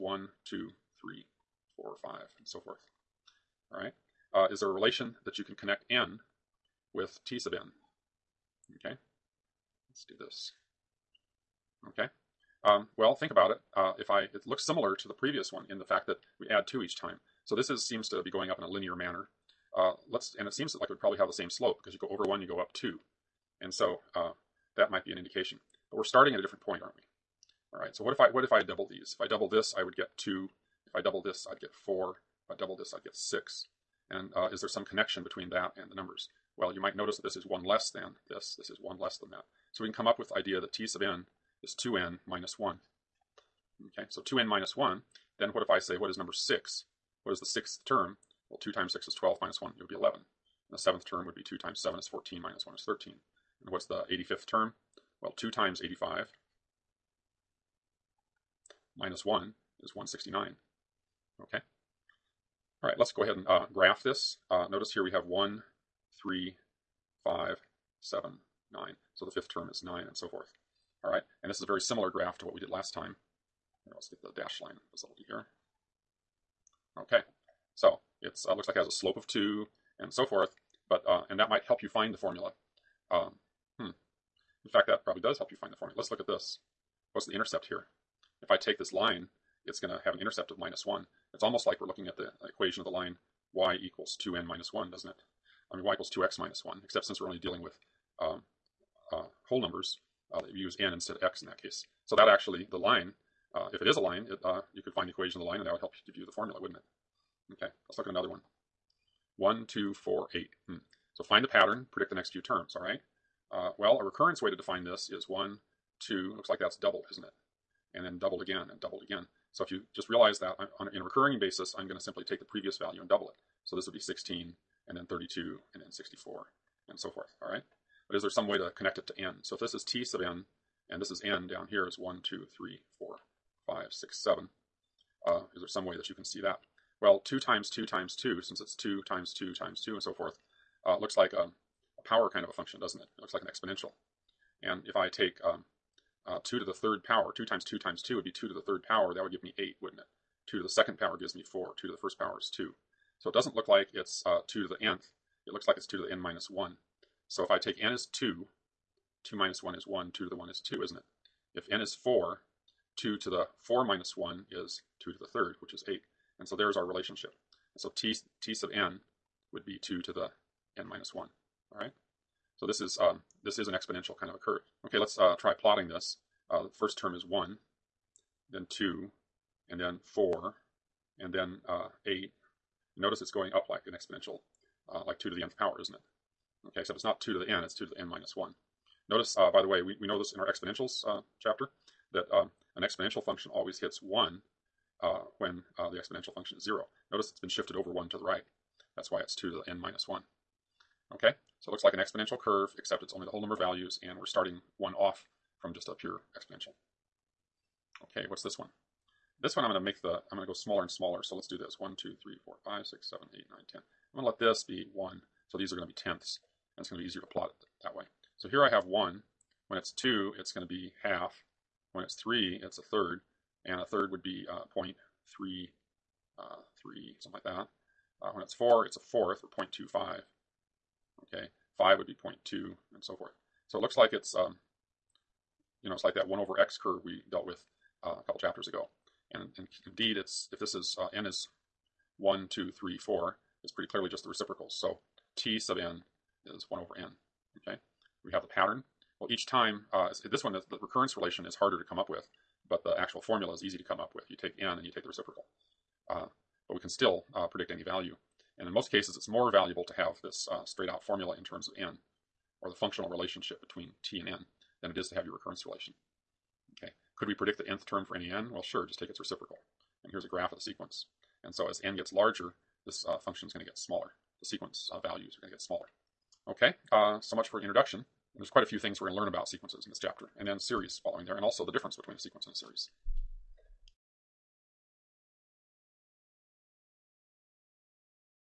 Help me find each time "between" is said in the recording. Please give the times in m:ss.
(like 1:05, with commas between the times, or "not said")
0:35, 4:23, 4:41.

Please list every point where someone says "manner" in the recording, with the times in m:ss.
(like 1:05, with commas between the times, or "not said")
0:18.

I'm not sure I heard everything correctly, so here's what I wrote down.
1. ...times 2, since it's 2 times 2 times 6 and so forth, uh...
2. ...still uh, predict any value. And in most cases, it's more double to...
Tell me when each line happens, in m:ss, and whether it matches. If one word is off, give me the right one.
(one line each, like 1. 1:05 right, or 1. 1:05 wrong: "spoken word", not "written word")
1. 2:17 wrong: "2", not "6"
2. 4:16 wrong: "valuable", not "double".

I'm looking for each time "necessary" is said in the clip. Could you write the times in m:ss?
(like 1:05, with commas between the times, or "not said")
not said.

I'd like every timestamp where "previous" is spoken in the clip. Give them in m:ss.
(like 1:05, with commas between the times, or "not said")
0:15, 2:02.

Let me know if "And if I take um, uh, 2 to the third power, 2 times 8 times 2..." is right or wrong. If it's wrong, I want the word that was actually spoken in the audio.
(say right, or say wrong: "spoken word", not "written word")
wrong: "2", not "8".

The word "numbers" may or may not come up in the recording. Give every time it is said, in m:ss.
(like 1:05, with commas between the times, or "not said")
0:35, 0:46, 1:39, 3:23.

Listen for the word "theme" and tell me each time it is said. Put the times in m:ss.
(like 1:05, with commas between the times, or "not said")
not said.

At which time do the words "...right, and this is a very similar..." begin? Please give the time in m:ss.
1:11.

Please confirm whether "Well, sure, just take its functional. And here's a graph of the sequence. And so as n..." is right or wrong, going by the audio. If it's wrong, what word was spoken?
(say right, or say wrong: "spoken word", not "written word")
wrong: "reciprocal", not "functional".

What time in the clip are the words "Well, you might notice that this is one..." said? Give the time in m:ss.
0:36.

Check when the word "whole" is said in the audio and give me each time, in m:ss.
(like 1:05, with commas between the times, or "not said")
1:39, 3:23.